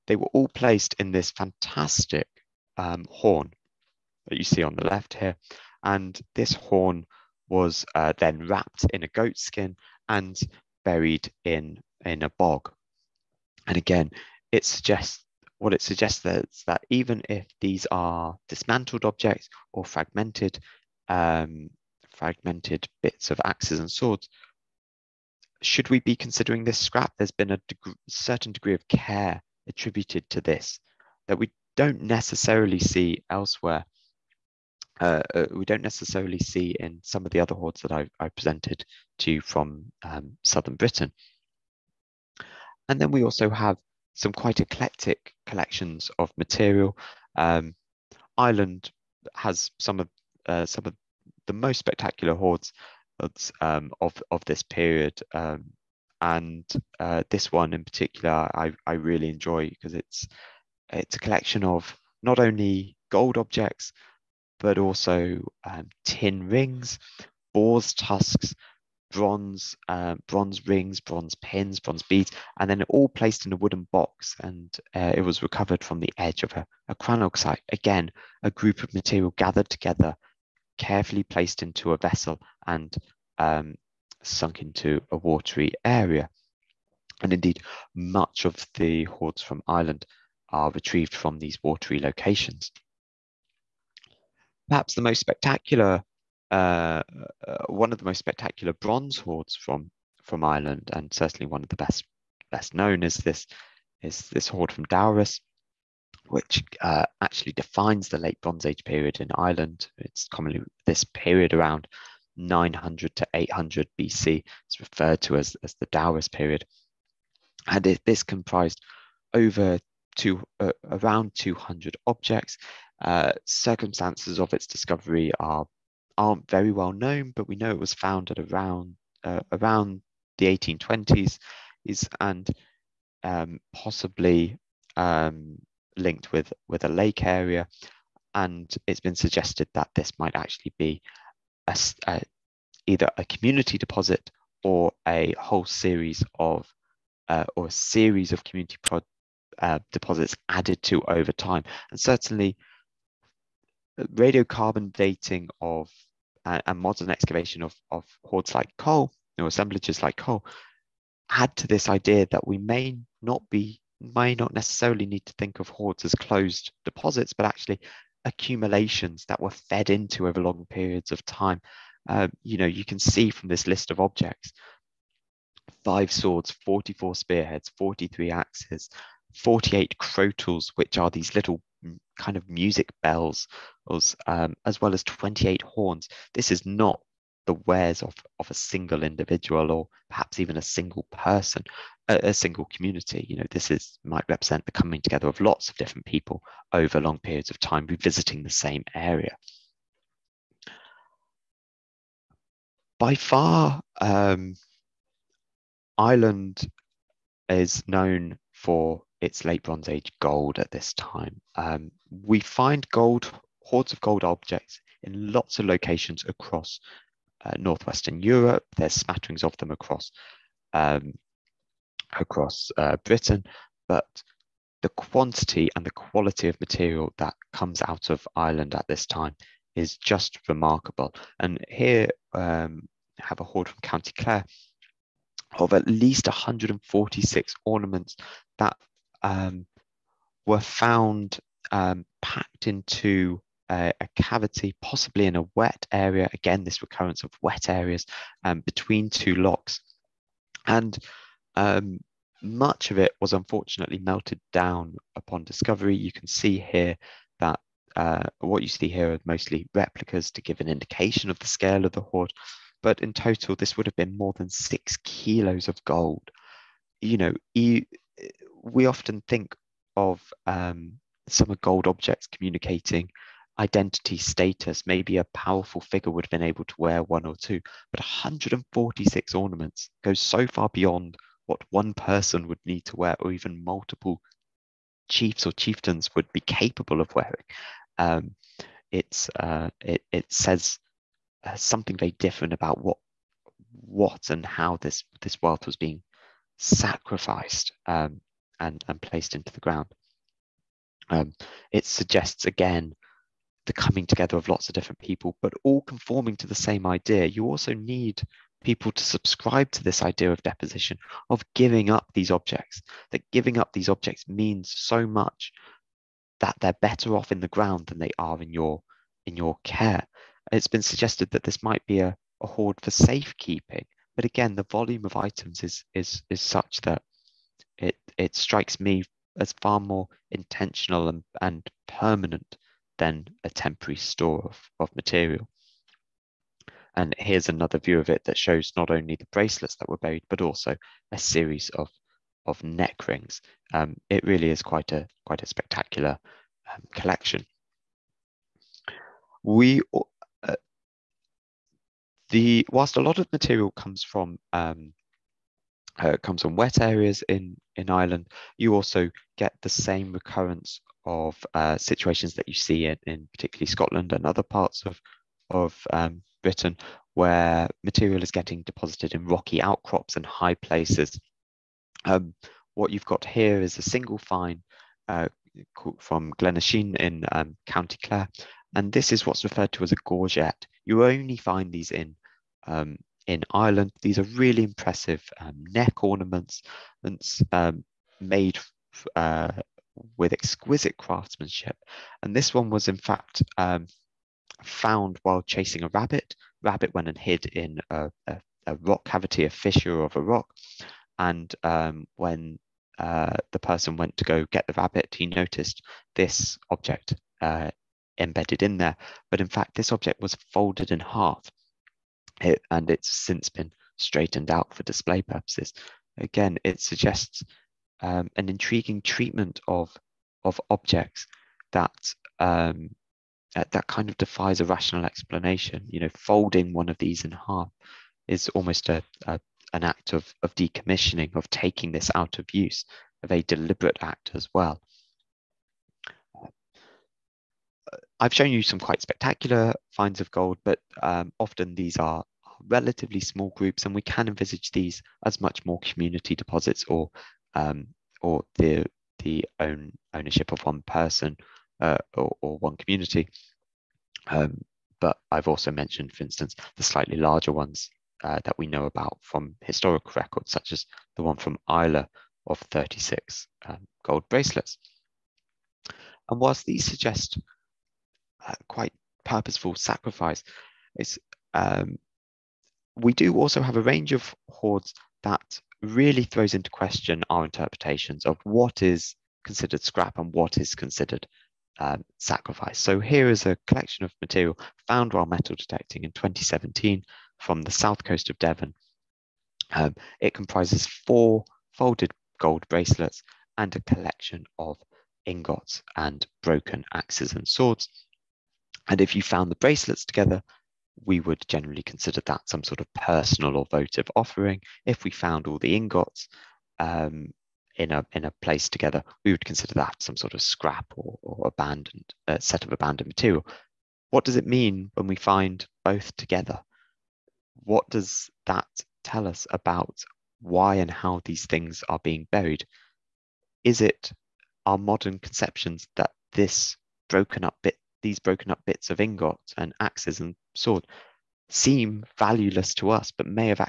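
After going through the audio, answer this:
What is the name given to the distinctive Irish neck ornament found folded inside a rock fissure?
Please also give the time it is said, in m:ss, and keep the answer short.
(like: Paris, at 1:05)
gorget, at 6:20.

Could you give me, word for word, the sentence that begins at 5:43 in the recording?
Um, it really is quite a quite a spectacular um, collection.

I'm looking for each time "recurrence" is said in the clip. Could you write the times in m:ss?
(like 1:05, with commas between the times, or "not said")
4:06, 6:00.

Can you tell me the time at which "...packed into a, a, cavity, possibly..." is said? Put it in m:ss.
4:02.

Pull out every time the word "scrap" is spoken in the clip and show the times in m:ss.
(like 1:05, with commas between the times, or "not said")
0:26, 7:59, 8:30.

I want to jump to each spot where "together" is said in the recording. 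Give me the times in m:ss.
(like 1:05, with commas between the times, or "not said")
1:19, 3:15, 5:04, 8:20, 8:28, 8:36.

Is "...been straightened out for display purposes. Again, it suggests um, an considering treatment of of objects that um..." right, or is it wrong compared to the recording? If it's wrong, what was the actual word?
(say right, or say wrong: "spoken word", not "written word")
wrong: "intriguing", not "considering".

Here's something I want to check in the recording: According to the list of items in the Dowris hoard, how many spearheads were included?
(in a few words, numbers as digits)
44.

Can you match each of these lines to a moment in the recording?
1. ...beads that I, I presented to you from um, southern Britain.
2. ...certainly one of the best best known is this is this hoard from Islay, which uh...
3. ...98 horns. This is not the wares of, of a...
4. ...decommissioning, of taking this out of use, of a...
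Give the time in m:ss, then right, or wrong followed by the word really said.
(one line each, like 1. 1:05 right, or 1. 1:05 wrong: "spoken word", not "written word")
1. 0:37 wrong: "hoards", not "beads"
2. 1:41 wrong: "Dowris", not "Islay"
3. 3:05 wrong: "28", not "98"
4. 7:10 right.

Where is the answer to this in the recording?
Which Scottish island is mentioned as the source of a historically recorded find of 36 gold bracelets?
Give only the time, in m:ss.
7:41.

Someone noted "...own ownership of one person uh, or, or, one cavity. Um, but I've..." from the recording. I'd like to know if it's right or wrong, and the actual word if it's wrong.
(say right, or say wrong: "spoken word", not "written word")
wrong: "community", not "cavity".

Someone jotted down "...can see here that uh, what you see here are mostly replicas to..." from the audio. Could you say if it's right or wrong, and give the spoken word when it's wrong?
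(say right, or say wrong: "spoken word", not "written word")
right.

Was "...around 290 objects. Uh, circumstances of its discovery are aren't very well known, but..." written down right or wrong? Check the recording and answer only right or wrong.
wrong.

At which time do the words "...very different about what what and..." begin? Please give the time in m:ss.
4:51.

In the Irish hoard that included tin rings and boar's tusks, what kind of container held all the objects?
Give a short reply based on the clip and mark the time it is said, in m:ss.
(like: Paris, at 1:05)
wooden box, at 1:13.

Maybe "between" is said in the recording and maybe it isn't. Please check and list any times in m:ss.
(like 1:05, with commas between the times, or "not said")
4:08.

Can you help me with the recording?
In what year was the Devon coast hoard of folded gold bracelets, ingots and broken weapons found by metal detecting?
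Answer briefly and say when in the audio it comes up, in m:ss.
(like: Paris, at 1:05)
2017, at 8:06.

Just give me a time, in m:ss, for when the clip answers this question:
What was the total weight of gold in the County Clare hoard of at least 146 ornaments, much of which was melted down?
4:24.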